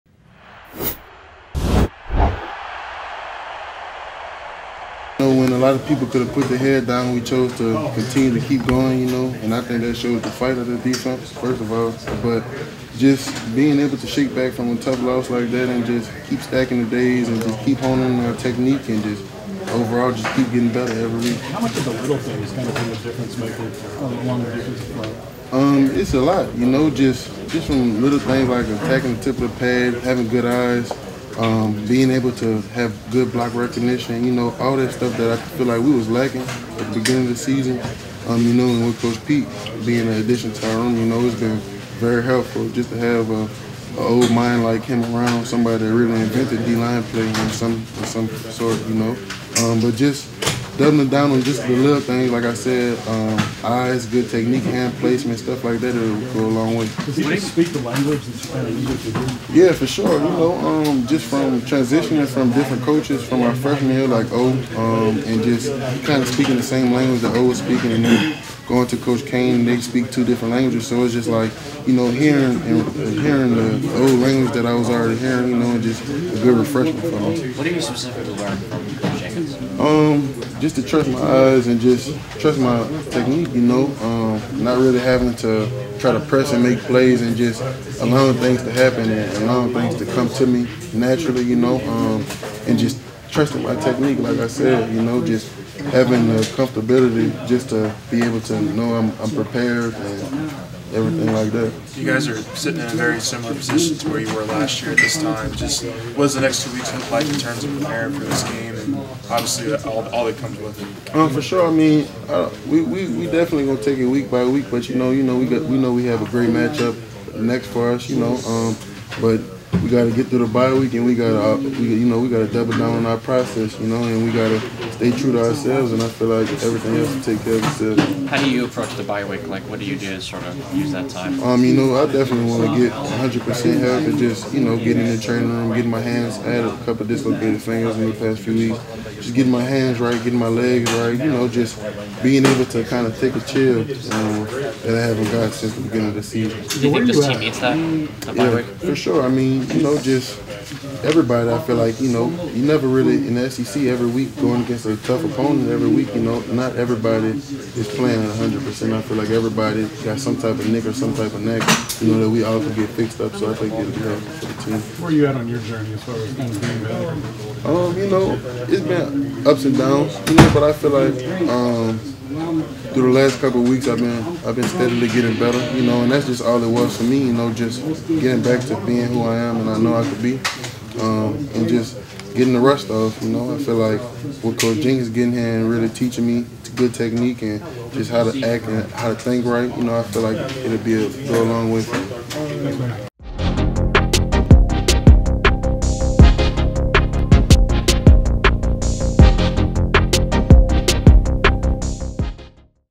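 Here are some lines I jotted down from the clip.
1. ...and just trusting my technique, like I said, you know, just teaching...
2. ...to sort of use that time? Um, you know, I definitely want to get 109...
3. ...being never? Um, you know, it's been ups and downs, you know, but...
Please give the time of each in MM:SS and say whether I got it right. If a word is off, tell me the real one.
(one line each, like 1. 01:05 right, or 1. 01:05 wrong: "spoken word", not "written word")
1. 01:32 wrong: "having", not "teaching"
2. 02:10 wrong: "100", not "109"
3. 02:46 wrong: "better", not "never".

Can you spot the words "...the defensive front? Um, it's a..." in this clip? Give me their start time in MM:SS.
00:24.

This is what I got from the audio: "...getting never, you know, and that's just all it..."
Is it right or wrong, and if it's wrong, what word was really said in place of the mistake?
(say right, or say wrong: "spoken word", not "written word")
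wrong: "better", not "never".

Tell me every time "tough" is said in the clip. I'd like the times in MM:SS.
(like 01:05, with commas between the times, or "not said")
00:14, 02:34.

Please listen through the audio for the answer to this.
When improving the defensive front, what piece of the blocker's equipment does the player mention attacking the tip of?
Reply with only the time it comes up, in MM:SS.
00:29.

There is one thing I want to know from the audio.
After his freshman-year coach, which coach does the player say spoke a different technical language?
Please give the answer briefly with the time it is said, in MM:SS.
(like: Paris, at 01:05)
Coach Cain, at 01:08.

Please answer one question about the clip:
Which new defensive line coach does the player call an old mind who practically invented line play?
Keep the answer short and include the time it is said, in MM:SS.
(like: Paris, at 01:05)
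Coach Pete, at 00:39.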